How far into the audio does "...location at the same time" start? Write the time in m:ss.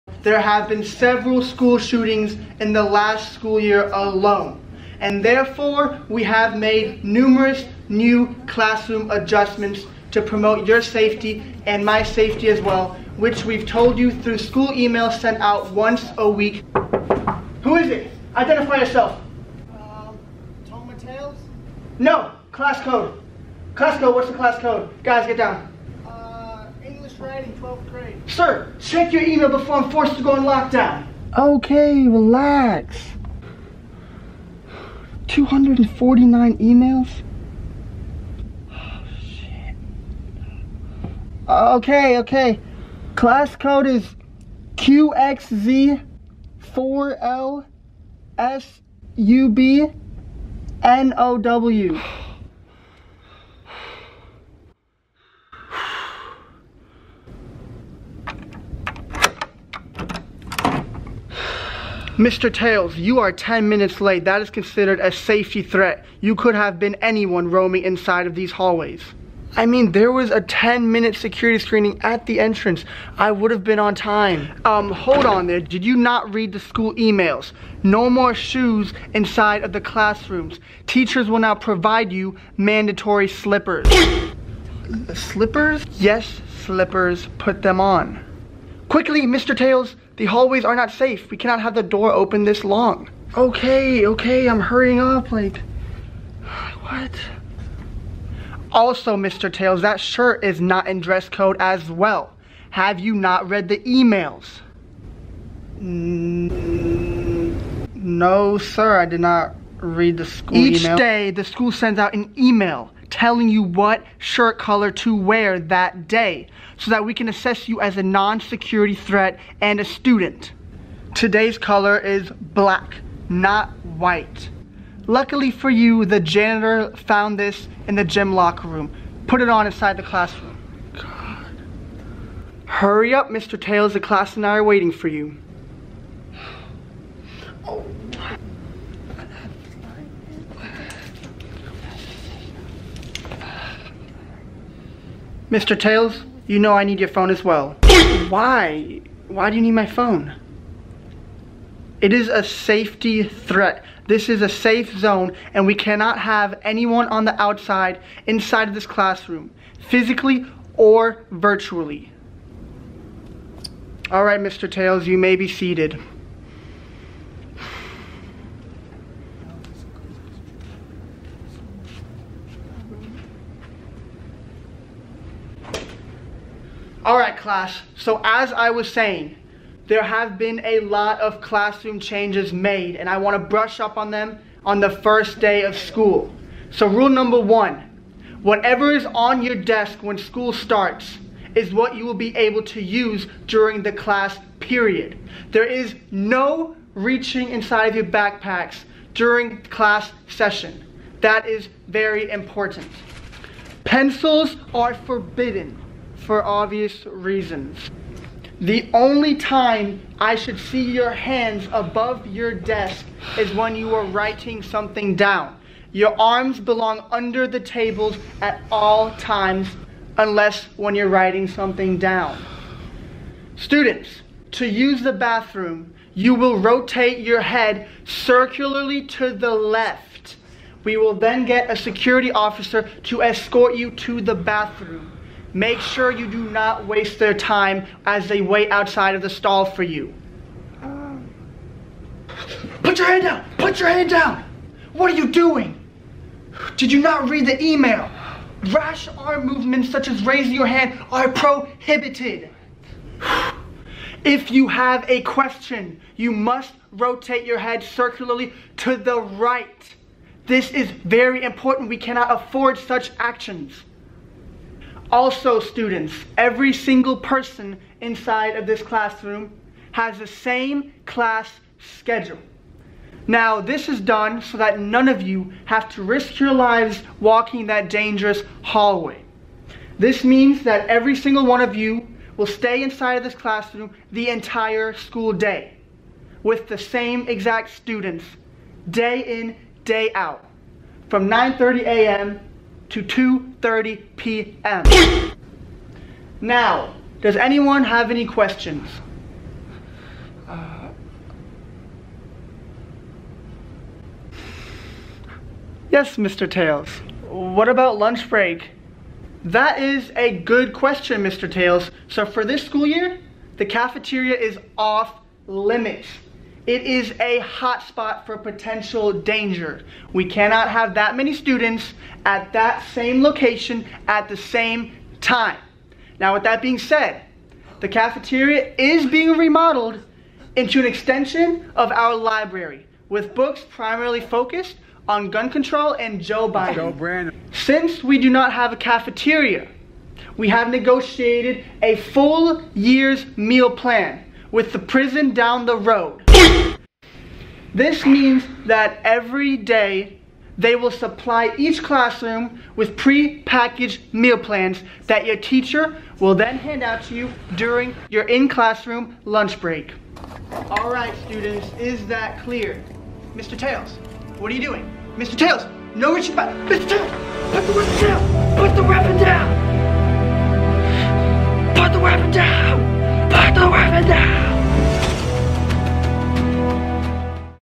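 5:23.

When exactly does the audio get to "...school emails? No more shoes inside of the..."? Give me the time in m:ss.
1:16.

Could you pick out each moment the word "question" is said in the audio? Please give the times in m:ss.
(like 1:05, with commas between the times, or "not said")
4:15, 4:58, 5:10.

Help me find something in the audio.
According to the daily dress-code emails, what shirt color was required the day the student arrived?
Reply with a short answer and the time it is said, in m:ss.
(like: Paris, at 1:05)
black, at 2:02.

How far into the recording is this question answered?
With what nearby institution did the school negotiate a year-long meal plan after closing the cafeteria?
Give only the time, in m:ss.
5:44.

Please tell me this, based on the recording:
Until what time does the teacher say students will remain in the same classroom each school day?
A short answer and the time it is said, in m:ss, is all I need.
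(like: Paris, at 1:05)
2:30 p.m., at 4:53.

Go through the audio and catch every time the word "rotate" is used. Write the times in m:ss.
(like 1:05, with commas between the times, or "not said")
3:46, 4:16.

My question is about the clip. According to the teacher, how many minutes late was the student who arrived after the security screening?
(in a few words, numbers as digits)
10.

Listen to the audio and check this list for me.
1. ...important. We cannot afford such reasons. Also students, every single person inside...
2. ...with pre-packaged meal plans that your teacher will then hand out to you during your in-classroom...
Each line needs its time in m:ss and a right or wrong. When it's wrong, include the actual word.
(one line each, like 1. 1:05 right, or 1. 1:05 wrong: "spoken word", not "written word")
1. 4:21 wrong: "actions", not "reasons"
2. 5:52 right.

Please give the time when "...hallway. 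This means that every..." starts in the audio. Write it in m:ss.
4:38.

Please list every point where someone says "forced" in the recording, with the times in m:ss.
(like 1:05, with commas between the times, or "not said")
0:29.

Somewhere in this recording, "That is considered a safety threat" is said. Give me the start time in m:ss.
1:04.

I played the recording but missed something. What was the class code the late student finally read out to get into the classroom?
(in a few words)
QXZ4LSUBNOW.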